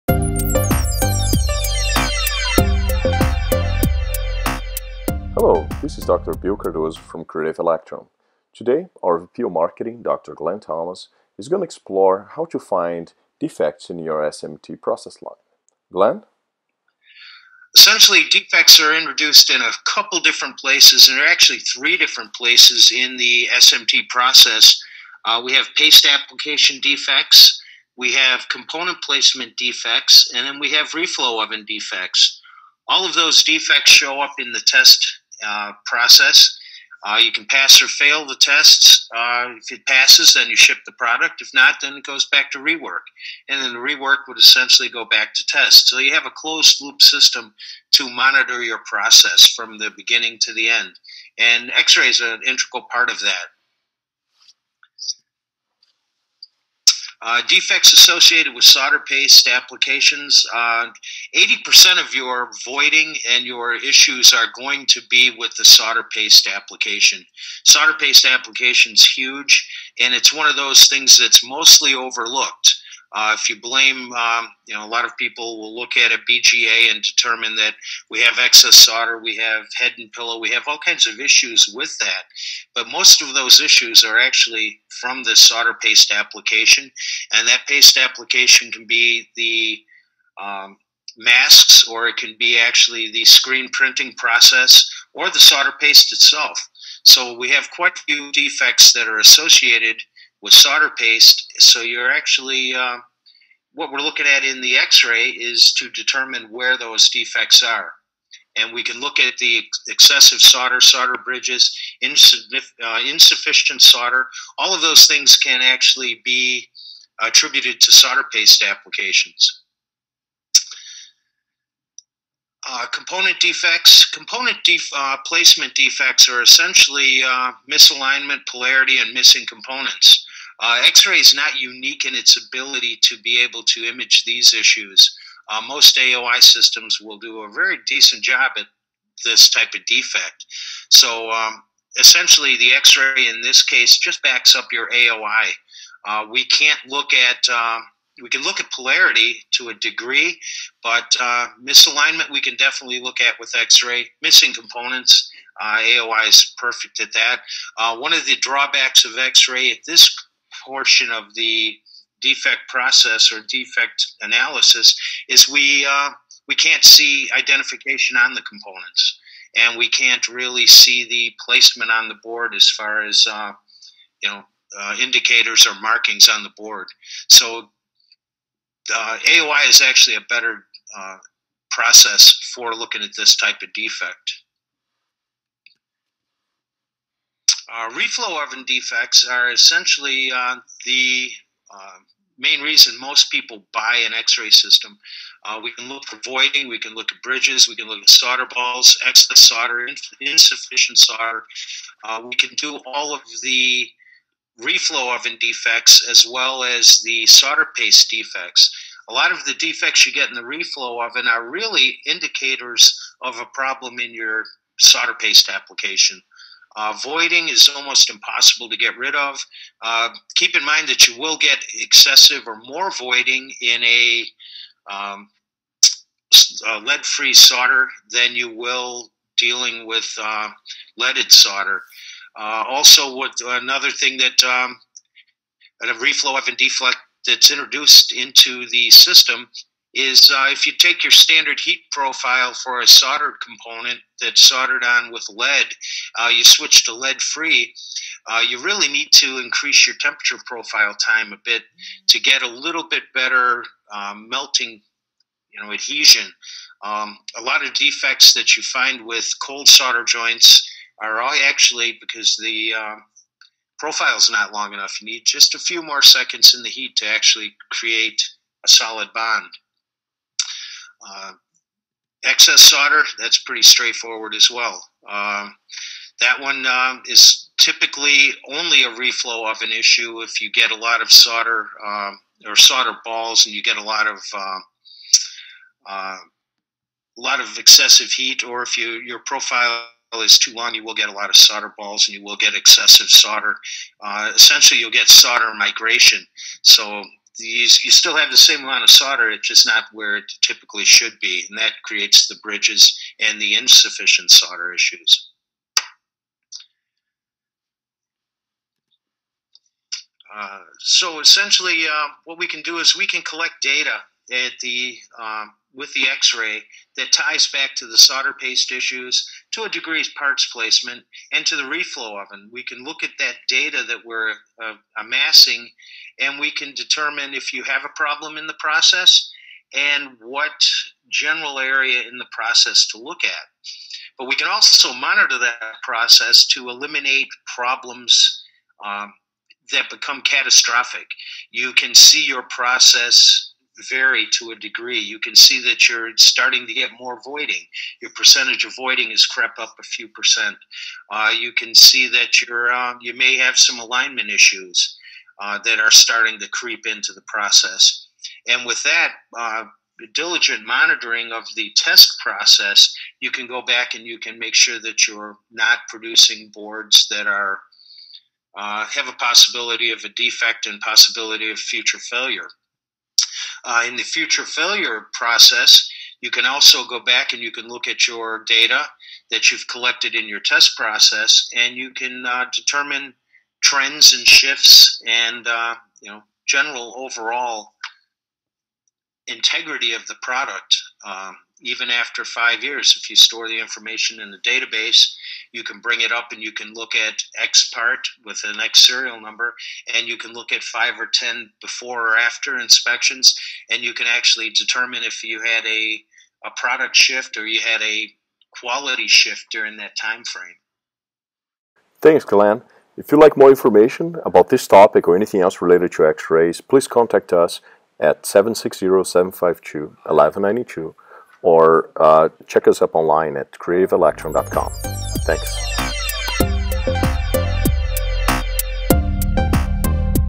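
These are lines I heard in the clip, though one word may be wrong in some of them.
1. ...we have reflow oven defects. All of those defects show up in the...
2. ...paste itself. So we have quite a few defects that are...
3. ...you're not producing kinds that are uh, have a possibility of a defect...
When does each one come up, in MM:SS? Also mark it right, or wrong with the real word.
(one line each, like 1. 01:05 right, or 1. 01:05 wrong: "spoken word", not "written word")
1. 00:30 right
2. 01:35 right
3. 06:05 wrong: "boards", not "kinds".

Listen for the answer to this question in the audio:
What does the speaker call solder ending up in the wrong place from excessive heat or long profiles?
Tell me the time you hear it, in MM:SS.
04:55.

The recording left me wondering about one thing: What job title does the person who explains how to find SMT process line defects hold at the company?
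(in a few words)
VP of Marketing.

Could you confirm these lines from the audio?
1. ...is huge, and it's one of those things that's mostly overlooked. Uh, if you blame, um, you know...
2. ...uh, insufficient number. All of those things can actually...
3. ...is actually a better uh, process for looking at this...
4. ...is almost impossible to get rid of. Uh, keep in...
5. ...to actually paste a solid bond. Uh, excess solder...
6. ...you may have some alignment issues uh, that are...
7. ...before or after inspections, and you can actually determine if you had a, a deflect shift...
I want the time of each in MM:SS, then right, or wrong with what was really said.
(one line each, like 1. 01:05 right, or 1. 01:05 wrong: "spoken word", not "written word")
1. 01:08 right
2. 01:52 wrong: "solder", not "number"
3. 02:59 right
4. 03:37 right
5. 04:26 wrong: "create", not "paste"
6. 05:53 right
7. 06:41 wrong: "product", not "deflect".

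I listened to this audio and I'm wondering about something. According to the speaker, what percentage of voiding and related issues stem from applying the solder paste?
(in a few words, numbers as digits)
80%.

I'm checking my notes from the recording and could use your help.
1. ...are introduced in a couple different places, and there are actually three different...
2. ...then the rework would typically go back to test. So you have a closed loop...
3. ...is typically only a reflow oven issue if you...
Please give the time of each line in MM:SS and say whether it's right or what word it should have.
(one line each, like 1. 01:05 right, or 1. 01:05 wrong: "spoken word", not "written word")
1. 00:18 right
2. 00:43 wrong: "essentially", not "typically"
3. 04:37 right.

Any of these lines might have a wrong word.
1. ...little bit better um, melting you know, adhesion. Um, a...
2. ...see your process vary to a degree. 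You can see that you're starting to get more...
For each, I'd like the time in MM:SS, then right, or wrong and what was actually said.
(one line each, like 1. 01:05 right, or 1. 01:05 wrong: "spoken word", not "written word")
1. 04:12 right
2. 05:41 right.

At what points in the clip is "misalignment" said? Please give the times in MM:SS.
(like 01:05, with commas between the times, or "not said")
02:07, 02:31.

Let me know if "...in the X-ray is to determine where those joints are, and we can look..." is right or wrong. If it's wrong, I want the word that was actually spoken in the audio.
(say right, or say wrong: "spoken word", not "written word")
wrong: "defects", not "joints".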